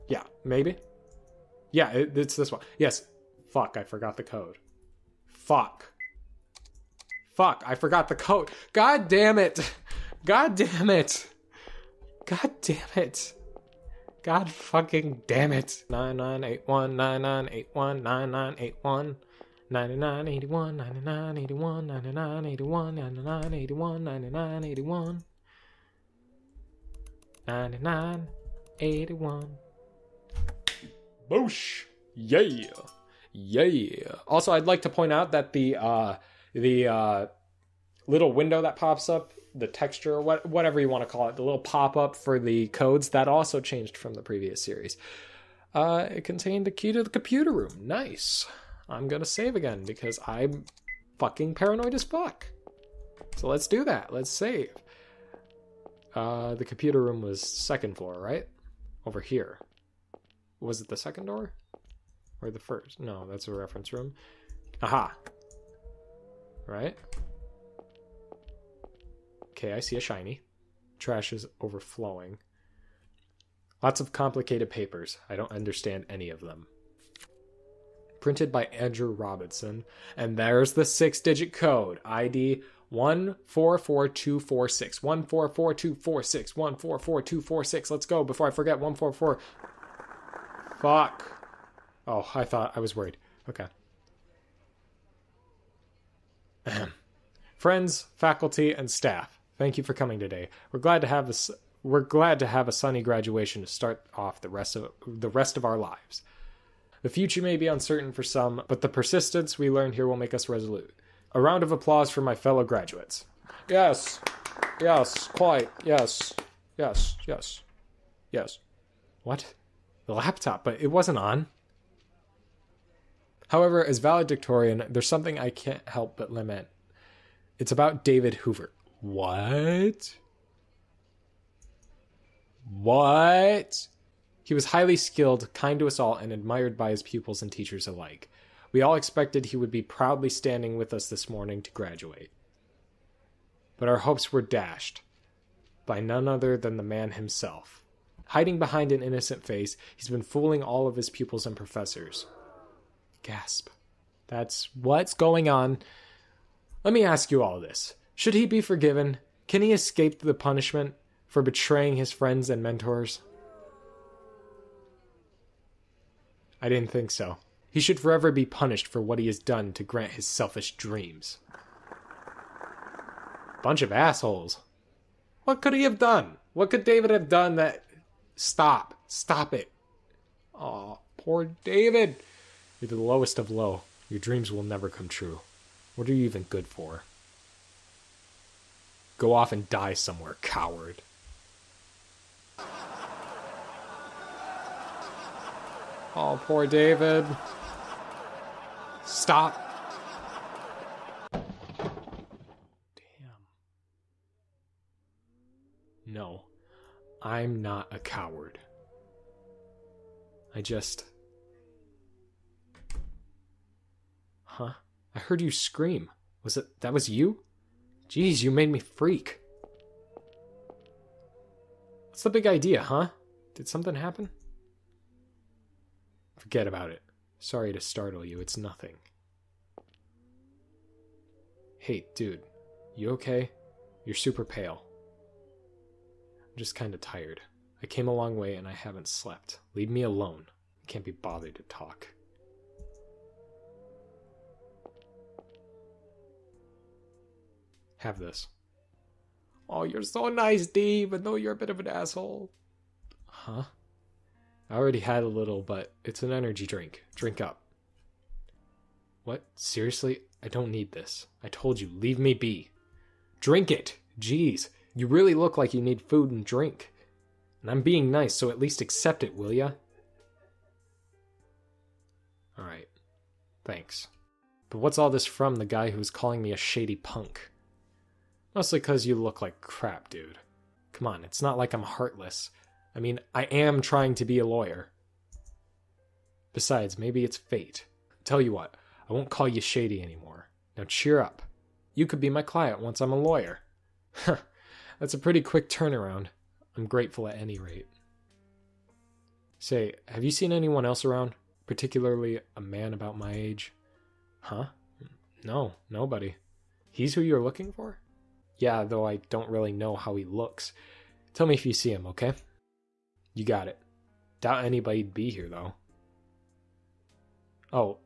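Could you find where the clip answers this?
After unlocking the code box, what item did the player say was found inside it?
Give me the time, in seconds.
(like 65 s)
46 s.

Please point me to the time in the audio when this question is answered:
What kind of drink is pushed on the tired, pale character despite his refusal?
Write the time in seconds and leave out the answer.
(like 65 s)
256 s.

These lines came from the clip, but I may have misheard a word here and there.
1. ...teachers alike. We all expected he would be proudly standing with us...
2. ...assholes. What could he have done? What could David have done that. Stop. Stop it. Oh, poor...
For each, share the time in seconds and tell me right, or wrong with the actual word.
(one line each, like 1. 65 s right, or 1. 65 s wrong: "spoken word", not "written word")
1. 137 s right
2. 173 s right.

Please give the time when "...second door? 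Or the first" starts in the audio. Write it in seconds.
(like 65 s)
60 s.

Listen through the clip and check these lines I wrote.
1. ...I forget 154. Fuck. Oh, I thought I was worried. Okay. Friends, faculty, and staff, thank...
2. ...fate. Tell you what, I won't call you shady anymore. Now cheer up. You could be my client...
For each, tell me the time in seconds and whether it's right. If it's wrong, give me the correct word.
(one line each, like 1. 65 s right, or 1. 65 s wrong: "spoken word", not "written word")
1. 88 s wrong: "144", not "154"
2. 287 s right.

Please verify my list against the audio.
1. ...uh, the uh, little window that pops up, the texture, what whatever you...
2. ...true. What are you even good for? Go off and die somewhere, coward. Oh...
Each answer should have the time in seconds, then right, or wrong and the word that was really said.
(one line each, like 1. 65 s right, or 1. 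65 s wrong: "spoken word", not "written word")
1. 35 s right
2. 185 s right.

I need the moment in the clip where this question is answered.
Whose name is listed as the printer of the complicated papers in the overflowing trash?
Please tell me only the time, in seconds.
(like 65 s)
78 s.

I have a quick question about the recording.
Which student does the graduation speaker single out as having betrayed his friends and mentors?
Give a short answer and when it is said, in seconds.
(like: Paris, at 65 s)
David Hoover, at 128 s.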